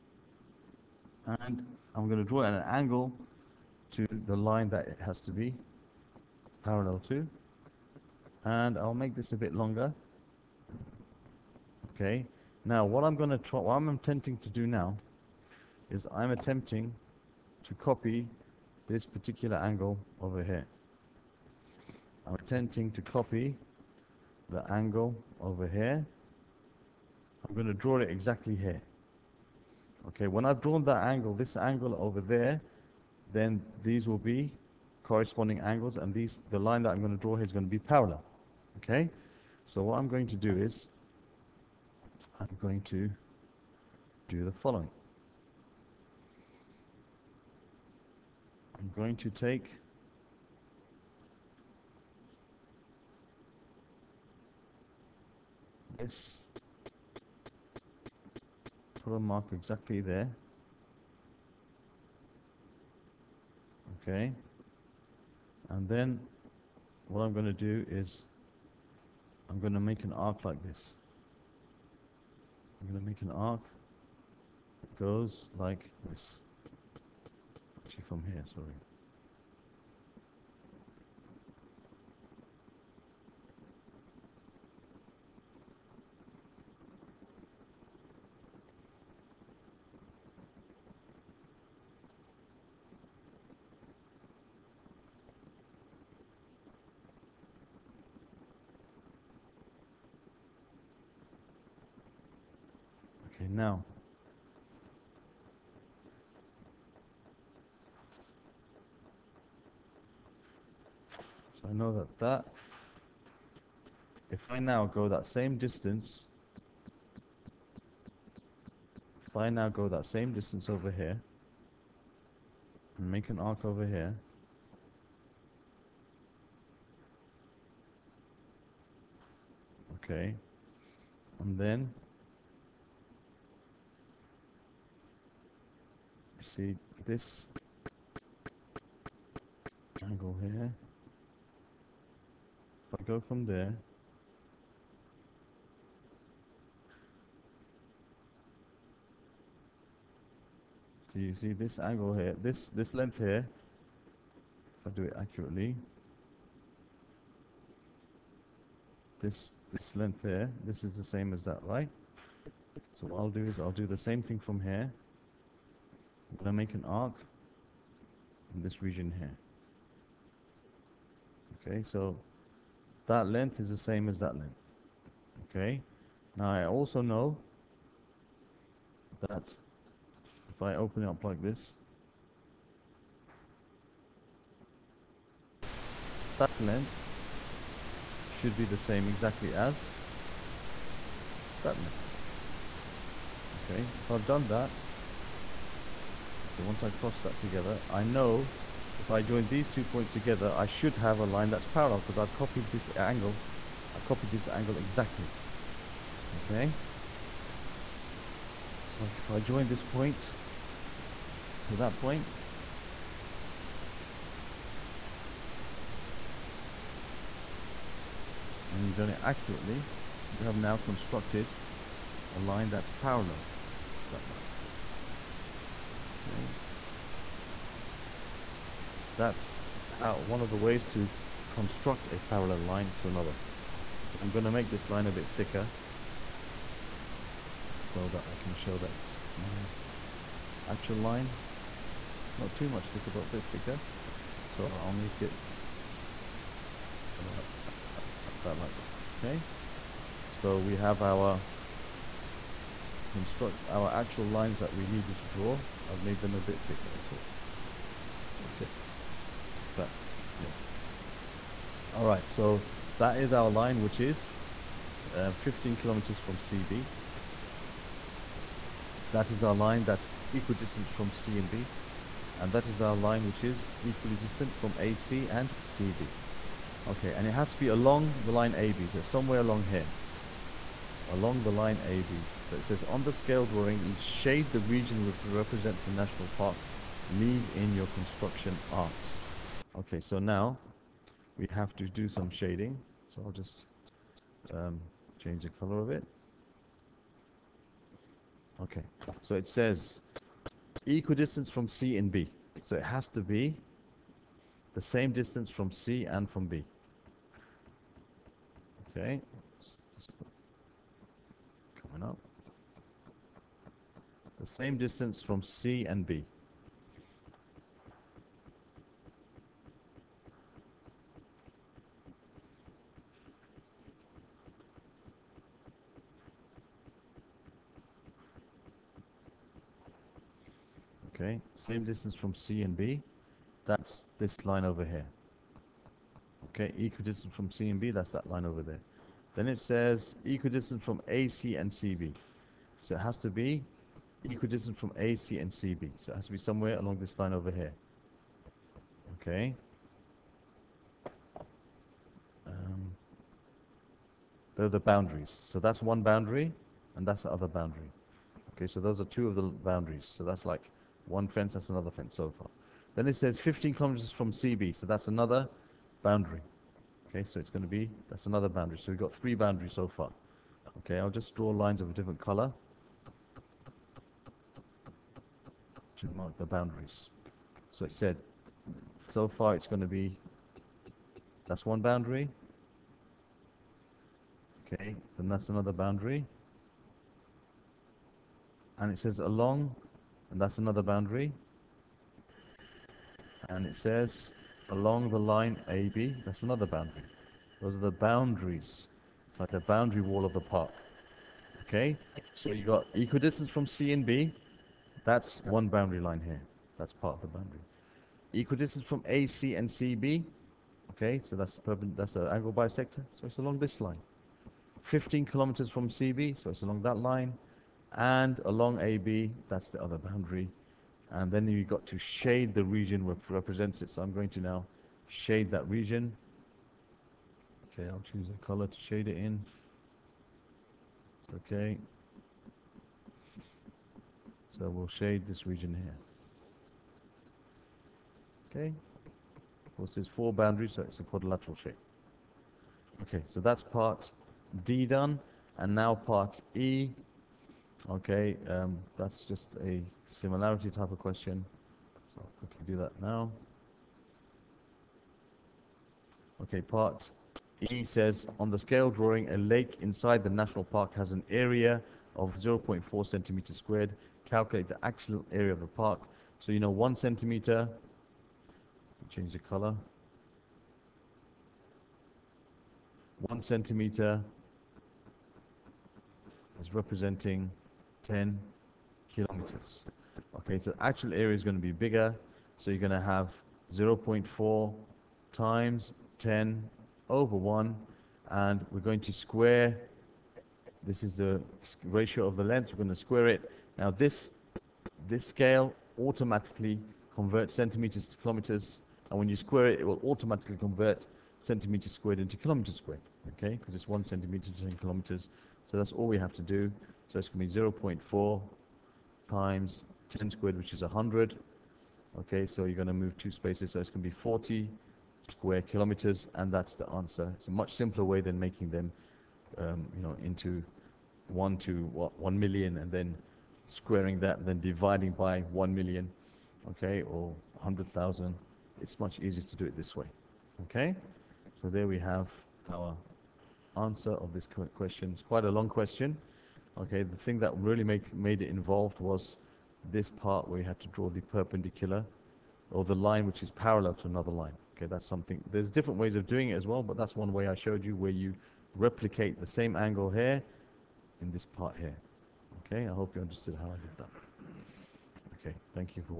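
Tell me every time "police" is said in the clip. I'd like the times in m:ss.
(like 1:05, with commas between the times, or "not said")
not said.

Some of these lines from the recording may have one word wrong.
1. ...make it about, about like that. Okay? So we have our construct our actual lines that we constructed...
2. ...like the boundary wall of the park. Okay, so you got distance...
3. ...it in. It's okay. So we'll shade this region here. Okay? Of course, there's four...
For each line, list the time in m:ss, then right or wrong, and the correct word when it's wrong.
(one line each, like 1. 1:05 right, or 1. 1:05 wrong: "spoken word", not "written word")
1. 4:04 wrong: "needed", not "constructed"
2. 6:39 wrong: "equidistance", not "distance"
3. 7:09 right.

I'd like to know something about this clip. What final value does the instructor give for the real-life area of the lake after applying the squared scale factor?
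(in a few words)
40 square kilometers.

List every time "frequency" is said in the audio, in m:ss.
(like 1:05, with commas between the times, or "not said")
not said.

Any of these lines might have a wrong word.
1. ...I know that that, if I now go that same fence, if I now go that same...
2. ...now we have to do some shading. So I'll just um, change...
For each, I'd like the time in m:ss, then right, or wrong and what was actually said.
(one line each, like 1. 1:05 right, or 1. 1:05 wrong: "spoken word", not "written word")
1. 1:51 wrong: "distance", not "fence"
2. 4:50 right.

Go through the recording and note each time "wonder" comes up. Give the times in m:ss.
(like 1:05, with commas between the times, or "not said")
not said.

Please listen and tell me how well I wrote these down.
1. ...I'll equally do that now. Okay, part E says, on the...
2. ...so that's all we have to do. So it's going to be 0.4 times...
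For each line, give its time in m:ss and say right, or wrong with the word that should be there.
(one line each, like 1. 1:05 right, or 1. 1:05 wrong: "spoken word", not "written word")
1. 7:32 wrong: "quickly", not "equally"
2. 8:25 right.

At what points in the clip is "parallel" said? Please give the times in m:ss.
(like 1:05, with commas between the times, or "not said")
0:06, 0:37, 3:21, 3:43, 3:52, 9:03.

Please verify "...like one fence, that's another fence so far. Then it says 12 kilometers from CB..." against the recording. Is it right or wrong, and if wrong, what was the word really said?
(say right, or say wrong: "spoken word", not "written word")
wrong: "15", not "12".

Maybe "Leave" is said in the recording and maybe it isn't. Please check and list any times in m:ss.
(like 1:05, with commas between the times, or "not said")
4:47.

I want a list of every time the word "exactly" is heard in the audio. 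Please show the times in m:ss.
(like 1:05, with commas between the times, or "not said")
0:28, 0:59, 3:09, 3:24.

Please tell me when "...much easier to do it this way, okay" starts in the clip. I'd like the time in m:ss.
8:48.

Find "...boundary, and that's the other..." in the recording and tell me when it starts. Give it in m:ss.
5:56.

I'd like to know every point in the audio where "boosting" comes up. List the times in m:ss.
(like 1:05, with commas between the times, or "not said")
not said.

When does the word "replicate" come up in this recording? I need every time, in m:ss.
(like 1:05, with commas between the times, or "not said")
9:08.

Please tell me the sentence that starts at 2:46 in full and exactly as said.
I'm gonna make an arc in this region here.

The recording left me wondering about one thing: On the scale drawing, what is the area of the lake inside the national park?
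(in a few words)
0.4 square centimeters.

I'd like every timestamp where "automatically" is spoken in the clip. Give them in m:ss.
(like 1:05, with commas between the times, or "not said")
8:15, 8:20.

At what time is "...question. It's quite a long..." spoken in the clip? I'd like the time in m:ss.
8:54.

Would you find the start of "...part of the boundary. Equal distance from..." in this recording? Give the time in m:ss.
6:46.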